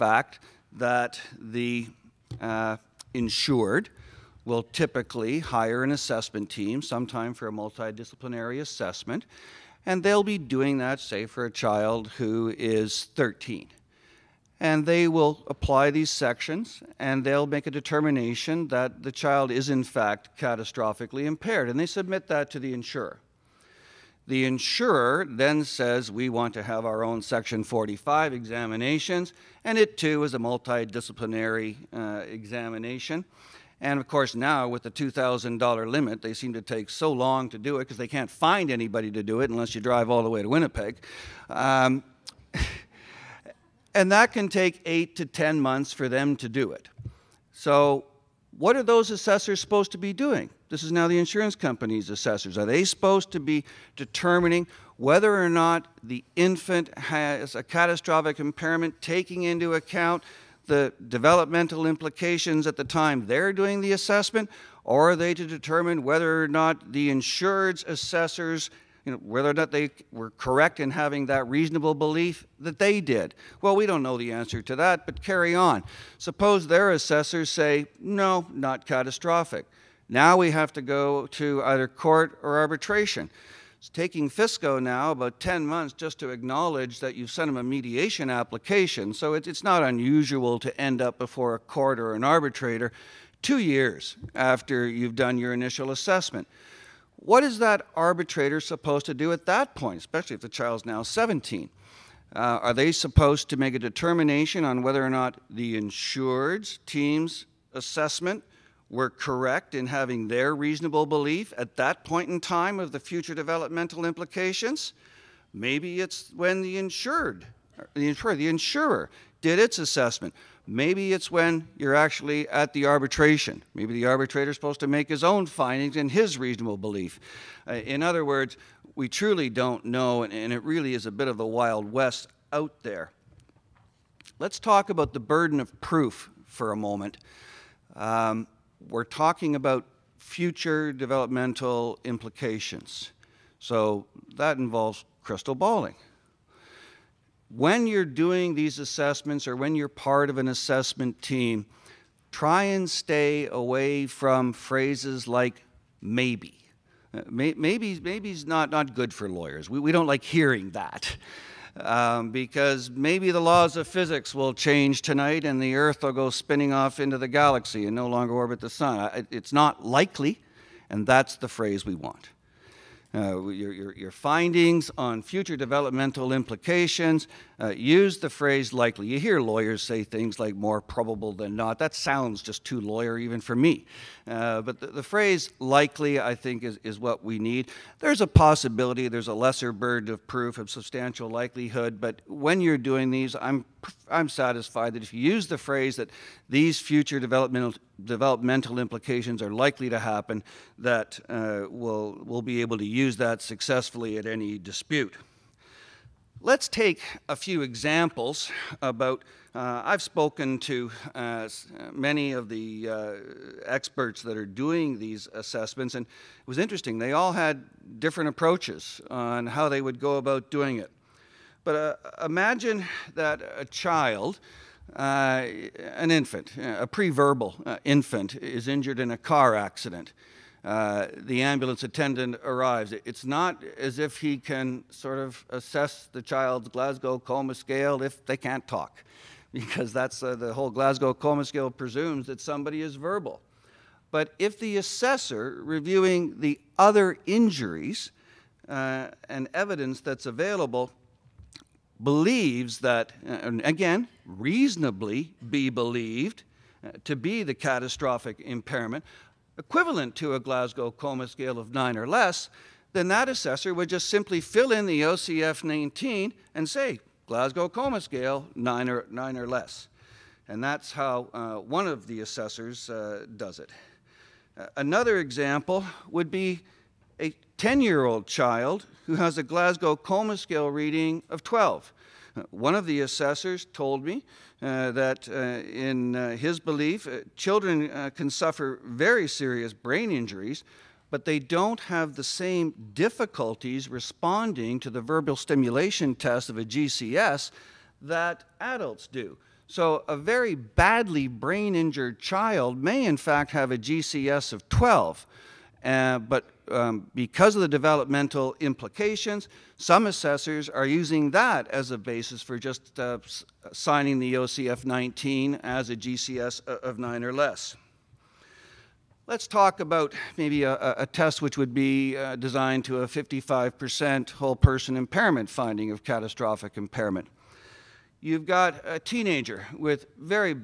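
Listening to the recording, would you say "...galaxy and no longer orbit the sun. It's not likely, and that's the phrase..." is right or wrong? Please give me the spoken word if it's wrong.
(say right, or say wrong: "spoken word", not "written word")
right.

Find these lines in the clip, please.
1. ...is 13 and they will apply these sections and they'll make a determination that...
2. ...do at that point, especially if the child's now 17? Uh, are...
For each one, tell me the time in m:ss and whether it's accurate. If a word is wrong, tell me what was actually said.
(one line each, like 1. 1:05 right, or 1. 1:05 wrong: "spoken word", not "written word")
1. 0:12 right
2. 1:39 right.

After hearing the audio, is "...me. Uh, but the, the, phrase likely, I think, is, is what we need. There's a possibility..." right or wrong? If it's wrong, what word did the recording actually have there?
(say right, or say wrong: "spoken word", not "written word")
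right.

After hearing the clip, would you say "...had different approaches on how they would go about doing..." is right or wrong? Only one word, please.
right.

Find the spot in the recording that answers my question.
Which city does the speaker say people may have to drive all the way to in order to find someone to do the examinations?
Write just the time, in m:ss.
0:40.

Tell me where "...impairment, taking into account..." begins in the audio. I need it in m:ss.
0:58.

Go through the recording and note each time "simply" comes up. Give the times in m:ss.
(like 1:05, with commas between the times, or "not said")
4:24.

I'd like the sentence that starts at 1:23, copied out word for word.
It's taking FSCO now about 10 months just to acknowledge that you have sent them a mediation application.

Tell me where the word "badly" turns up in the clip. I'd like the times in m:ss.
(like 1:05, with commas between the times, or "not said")
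5:00.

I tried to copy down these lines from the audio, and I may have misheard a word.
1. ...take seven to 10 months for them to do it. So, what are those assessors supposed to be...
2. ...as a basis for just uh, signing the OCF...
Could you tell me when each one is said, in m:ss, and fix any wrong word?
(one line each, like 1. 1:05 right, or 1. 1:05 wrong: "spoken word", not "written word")
1. 0:44 wrong: "eight", not "seven"
2. 5:11 right.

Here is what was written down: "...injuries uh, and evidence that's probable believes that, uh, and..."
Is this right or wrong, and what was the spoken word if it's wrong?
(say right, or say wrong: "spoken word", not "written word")
wrong: "available", not "probable".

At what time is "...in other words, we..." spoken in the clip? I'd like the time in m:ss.
2:07.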